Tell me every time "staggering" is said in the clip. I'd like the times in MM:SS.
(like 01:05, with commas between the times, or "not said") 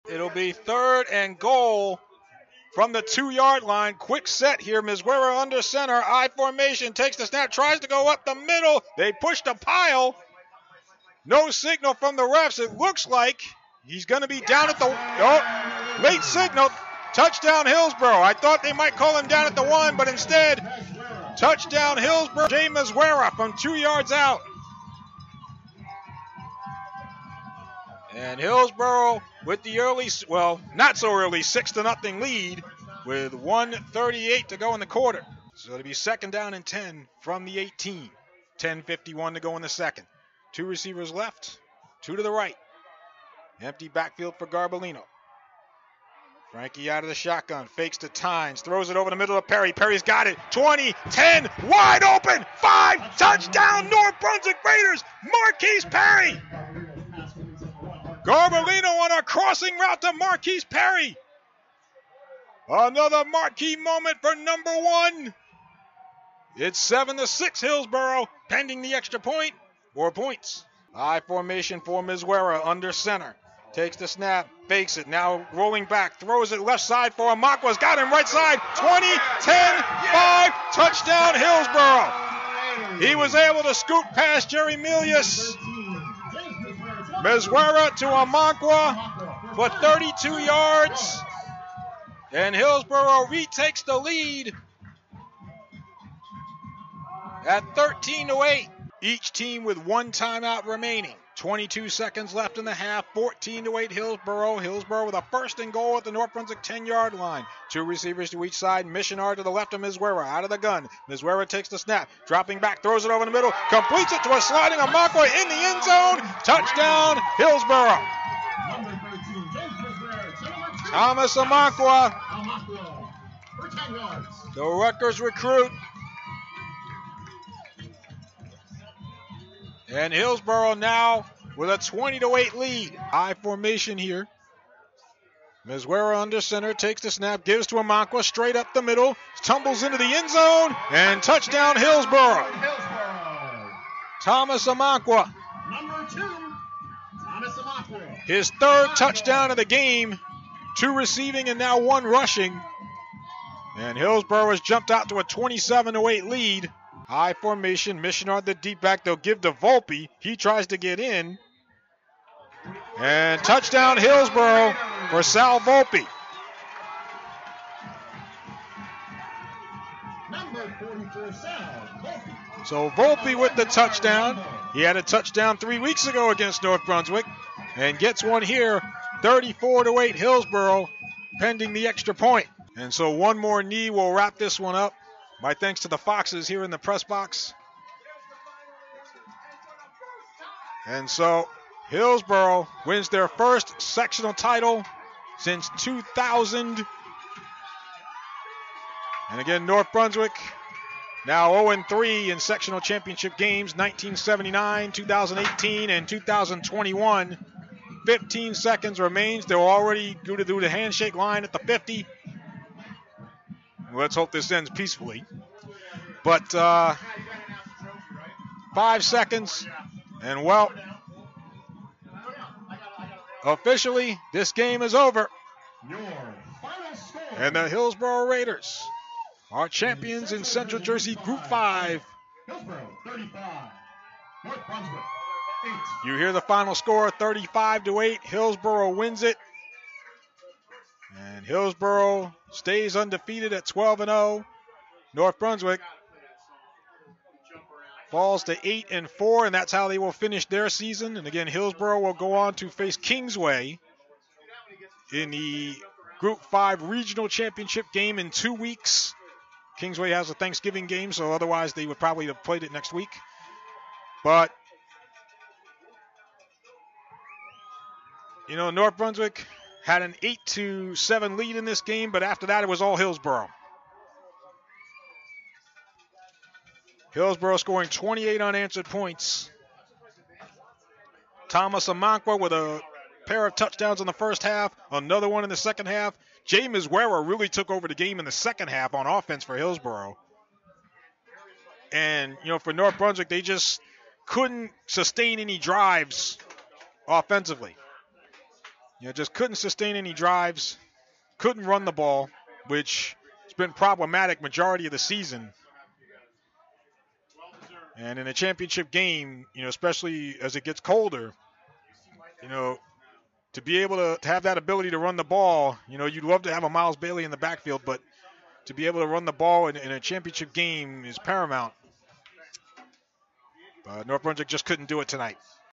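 not said.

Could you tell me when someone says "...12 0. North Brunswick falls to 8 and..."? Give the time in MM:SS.
04:03.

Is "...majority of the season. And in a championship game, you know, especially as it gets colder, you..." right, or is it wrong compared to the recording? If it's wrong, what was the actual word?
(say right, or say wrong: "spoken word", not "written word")
right.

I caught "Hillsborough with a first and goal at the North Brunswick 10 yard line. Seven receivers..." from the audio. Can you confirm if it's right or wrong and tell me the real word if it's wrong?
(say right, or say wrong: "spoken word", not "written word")
wrong: "Two", not "Seven".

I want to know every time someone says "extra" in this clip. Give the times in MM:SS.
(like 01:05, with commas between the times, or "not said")
01:08, 03:01.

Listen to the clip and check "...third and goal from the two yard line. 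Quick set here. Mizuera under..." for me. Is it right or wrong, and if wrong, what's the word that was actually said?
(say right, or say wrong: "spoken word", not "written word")
right.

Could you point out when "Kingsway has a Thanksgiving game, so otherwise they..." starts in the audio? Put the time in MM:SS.
04:19.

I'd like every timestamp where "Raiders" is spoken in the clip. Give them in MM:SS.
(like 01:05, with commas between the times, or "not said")
00:54, 03:48.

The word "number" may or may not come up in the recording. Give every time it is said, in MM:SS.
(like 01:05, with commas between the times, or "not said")
01:04, 02:25.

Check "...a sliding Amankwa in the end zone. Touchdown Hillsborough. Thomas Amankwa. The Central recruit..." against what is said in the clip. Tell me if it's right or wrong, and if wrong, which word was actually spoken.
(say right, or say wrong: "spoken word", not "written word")
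wrong: "Rutgers", not "Central".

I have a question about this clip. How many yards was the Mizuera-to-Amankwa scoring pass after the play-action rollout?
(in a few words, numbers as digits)
32.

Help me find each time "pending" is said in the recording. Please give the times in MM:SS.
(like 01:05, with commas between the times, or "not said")
01:08, 03:01.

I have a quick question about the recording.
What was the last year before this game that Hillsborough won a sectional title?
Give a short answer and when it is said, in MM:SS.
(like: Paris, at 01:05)
2000, at 03:15.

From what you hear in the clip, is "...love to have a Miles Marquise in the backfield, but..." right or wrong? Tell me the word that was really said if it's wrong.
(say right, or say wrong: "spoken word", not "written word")
wrong: "Bailey", not "Marquise".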